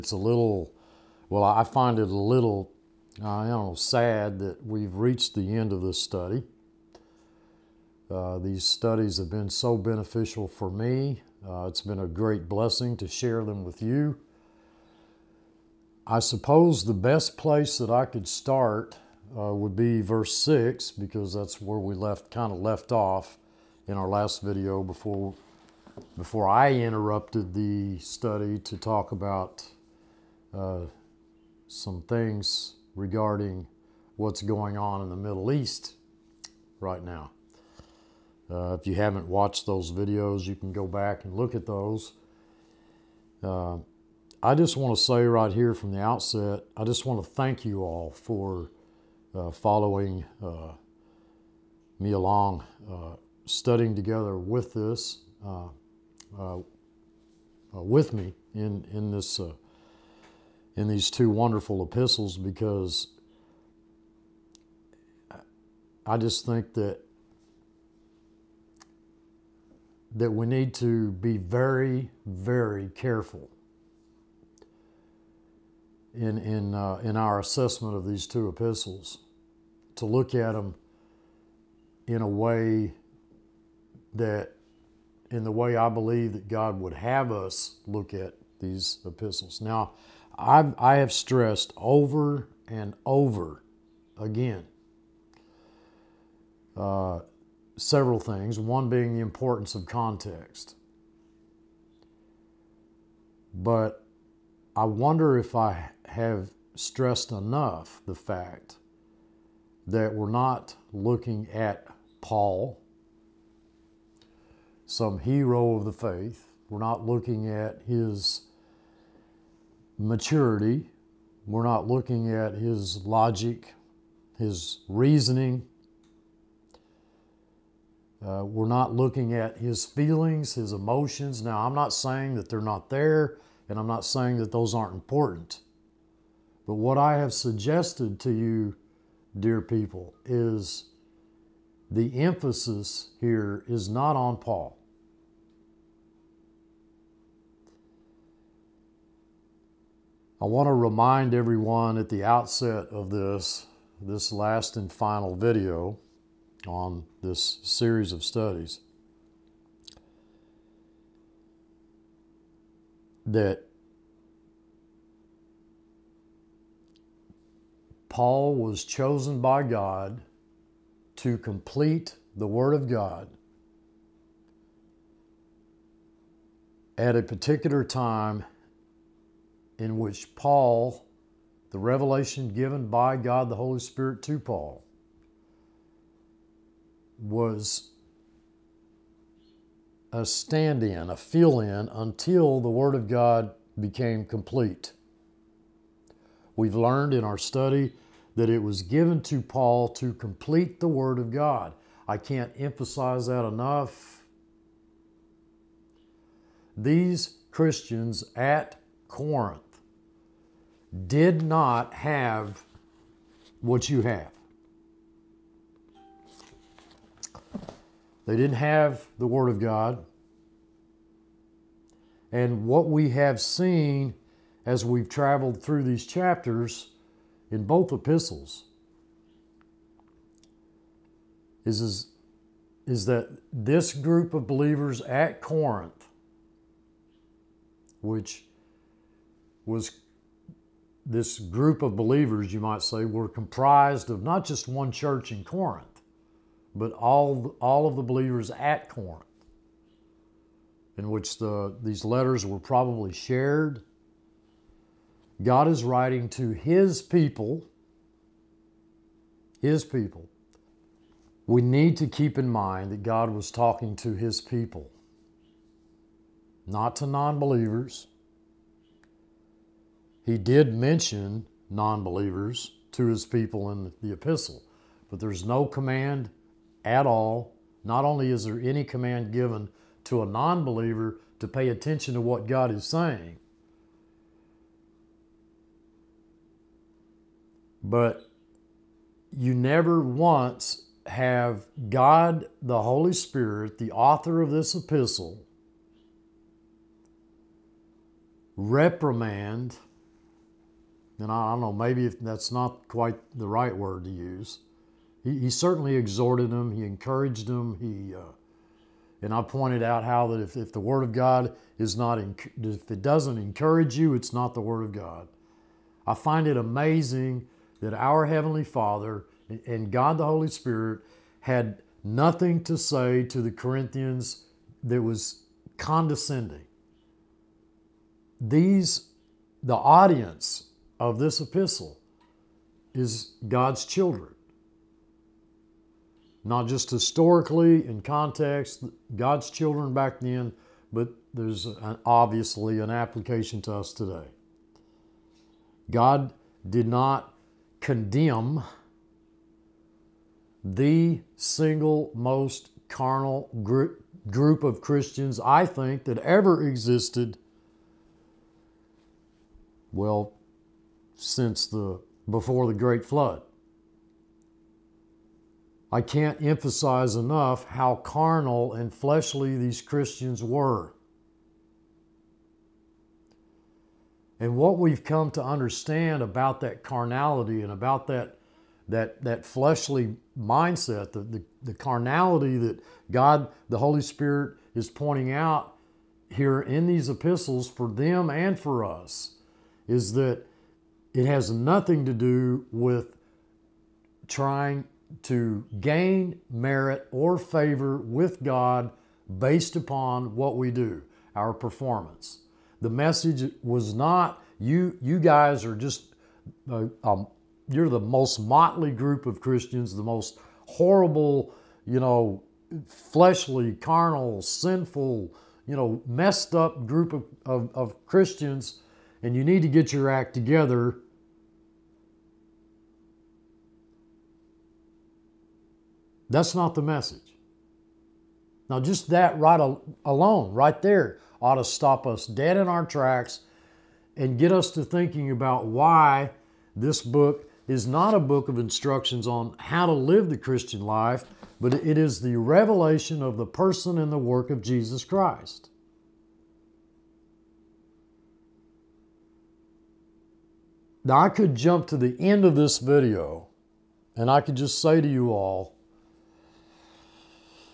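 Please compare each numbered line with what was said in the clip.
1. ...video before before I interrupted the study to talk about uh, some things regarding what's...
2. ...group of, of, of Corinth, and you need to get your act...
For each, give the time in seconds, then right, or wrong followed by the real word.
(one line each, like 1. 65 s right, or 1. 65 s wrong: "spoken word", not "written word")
1. 24 s right
2. 416 s wrong: "Christians", not "Corinth".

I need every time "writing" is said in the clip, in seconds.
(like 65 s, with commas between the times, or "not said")
255 s.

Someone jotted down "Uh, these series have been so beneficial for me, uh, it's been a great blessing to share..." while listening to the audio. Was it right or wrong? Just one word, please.
wrong.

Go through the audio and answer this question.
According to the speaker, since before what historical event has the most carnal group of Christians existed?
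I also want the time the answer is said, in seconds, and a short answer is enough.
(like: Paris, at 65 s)
the Great Flood, at 362 s.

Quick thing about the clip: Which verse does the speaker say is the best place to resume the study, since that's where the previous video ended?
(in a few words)
Verse 6.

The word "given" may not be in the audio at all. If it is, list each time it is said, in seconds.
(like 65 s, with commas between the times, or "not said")
182 s, 198 s, 279 s.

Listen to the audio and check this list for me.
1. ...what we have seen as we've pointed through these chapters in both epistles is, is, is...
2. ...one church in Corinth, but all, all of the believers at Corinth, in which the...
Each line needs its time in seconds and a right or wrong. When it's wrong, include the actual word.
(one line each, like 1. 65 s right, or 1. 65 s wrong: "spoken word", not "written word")
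1. 222 s wrong: "traveled", not "pointed"
2. 244 s right.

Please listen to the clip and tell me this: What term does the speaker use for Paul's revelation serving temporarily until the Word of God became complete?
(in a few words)
a stand in.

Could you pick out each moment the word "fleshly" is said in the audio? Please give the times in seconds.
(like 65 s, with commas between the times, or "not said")
368 s, 379 s, 412 s.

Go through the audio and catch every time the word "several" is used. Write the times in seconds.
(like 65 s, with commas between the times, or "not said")
97 s.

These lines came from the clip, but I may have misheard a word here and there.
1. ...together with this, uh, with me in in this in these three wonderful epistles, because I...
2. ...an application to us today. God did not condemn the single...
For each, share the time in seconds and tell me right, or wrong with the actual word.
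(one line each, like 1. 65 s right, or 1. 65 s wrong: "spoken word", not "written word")
1. 53 s wrong: "two", not "three"
2. 342 s right.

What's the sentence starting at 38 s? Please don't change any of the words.
Uh, if you haven't watched those videos, you can go back and look at those.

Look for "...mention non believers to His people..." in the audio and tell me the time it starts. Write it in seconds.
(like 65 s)
270 s.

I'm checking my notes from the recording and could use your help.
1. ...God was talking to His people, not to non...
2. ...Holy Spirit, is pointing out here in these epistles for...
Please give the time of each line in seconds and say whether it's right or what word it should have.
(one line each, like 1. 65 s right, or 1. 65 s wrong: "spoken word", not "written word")
1. 263 s right
2. 383 s right.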